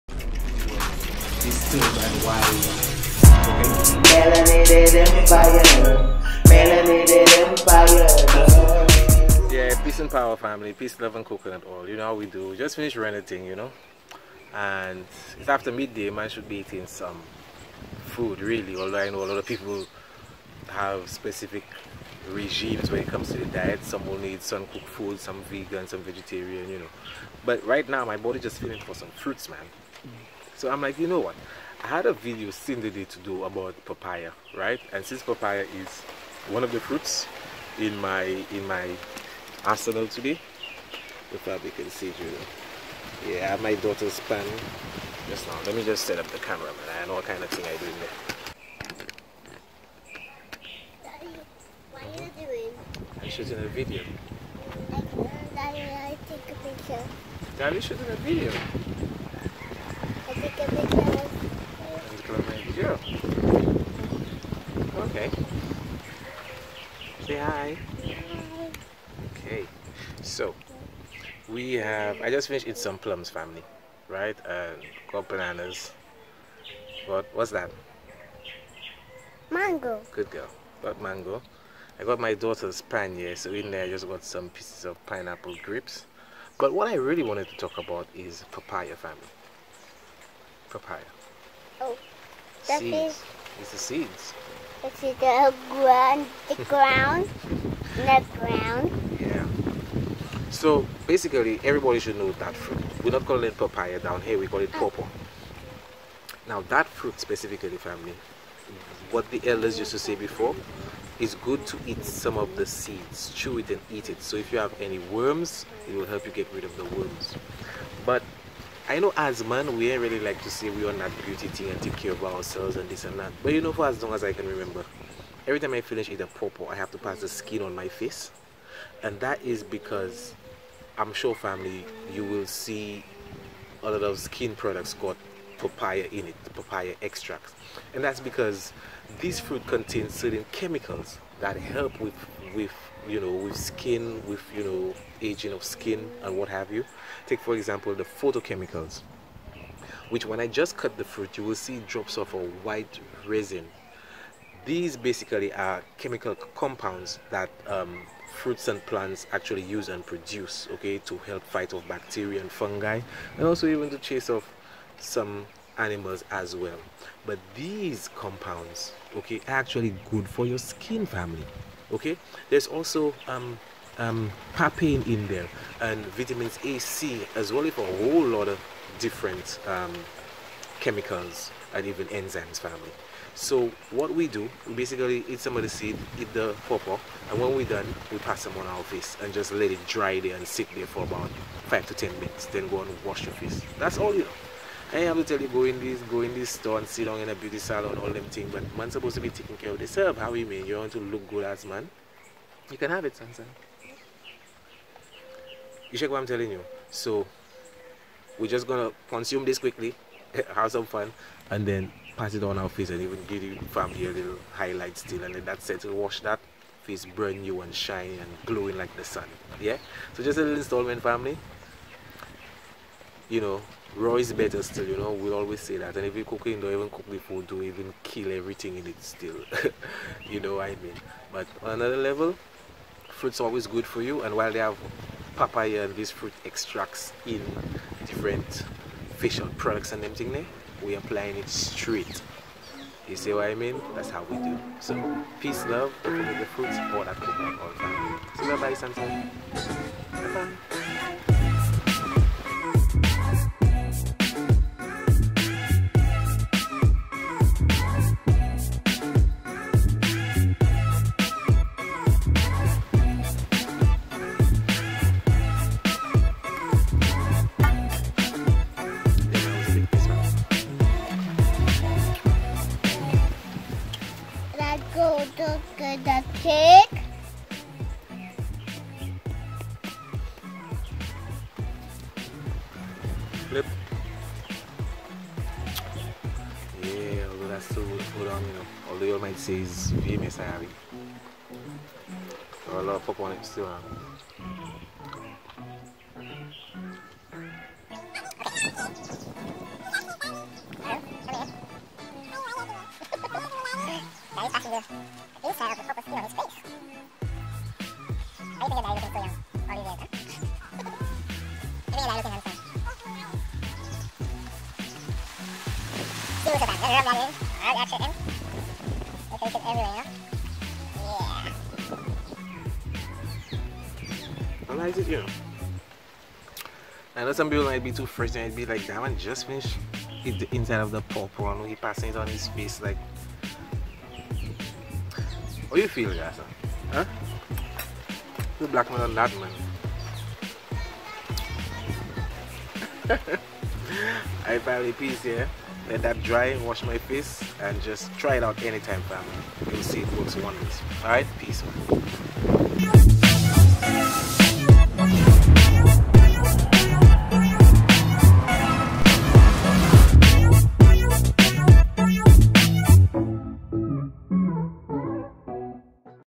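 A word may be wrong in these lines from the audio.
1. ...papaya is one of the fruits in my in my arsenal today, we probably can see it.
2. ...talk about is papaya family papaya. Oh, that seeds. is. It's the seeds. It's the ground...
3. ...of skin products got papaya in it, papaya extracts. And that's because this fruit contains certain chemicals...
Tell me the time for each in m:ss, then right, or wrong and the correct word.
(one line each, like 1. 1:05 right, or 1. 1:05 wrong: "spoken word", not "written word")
1. 0:35 right
2. 1:27 right
3. 2:14 right.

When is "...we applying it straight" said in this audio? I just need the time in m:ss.
4:00.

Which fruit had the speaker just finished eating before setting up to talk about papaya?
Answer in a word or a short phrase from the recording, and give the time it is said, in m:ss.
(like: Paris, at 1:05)
Plums, at 1:12.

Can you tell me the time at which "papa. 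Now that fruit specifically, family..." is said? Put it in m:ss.
1:44.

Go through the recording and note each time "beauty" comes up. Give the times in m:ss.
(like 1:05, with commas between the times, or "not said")
2:01, 3:17.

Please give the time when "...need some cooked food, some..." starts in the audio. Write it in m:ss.
0:24.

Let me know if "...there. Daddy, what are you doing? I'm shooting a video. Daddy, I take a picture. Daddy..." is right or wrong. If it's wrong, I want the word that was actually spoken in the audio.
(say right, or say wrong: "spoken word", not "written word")
right.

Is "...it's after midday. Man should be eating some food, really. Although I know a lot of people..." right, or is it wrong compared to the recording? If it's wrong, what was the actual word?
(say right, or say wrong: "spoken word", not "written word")
right.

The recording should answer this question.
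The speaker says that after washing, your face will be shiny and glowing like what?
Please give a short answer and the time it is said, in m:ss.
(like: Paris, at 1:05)
The sun, at 3:38.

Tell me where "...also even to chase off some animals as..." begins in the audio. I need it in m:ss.
2:43.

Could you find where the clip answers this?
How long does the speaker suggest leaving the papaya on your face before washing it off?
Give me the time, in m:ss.
3:11.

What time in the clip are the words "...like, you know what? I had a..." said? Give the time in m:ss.
0:30.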